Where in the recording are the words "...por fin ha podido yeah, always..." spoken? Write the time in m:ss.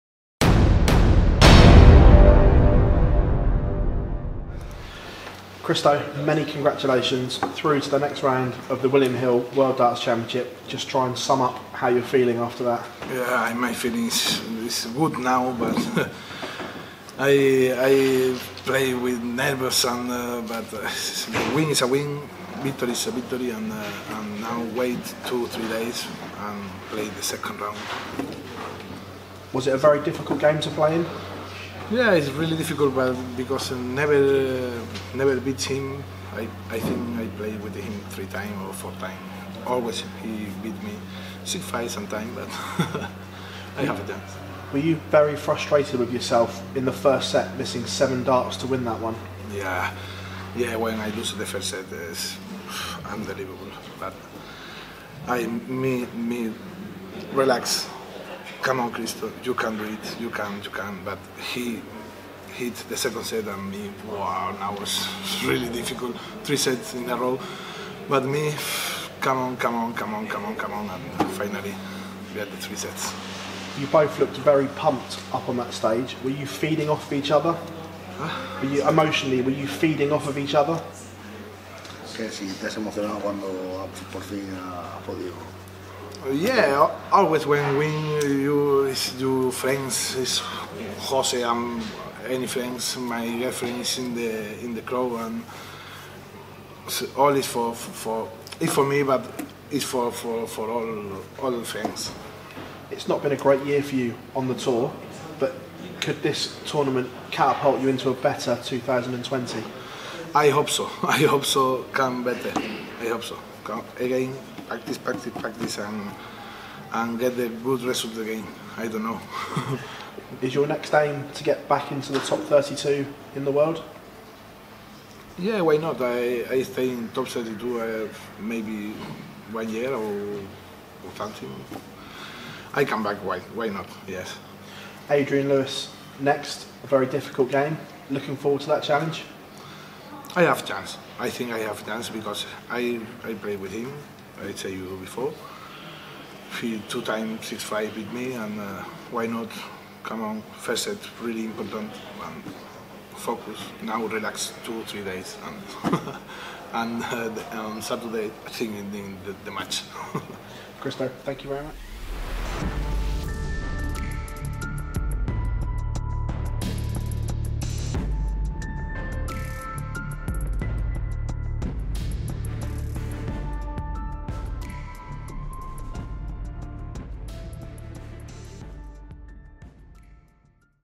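1:24.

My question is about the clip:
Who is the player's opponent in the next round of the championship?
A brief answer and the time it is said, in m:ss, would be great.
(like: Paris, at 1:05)
Adrian Lewis, at 2:15.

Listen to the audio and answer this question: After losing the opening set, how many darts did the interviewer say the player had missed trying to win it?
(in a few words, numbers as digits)
7.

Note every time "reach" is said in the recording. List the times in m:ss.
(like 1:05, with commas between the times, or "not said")
not said.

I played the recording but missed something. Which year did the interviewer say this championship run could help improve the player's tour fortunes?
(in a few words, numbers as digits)
2020.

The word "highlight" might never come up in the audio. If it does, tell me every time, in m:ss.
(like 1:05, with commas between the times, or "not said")
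not said.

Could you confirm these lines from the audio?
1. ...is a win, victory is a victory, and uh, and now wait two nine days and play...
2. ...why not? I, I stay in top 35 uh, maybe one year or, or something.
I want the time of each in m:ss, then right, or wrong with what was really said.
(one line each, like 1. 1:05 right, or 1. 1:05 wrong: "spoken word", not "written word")
1. 0:21 wrong: "three", not "nine"
2. 2:05 wrong: "32", not "35".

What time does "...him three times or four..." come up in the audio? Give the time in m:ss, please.
0:37.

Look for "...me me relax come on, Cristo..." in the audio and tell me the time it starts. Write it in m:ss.
0:55.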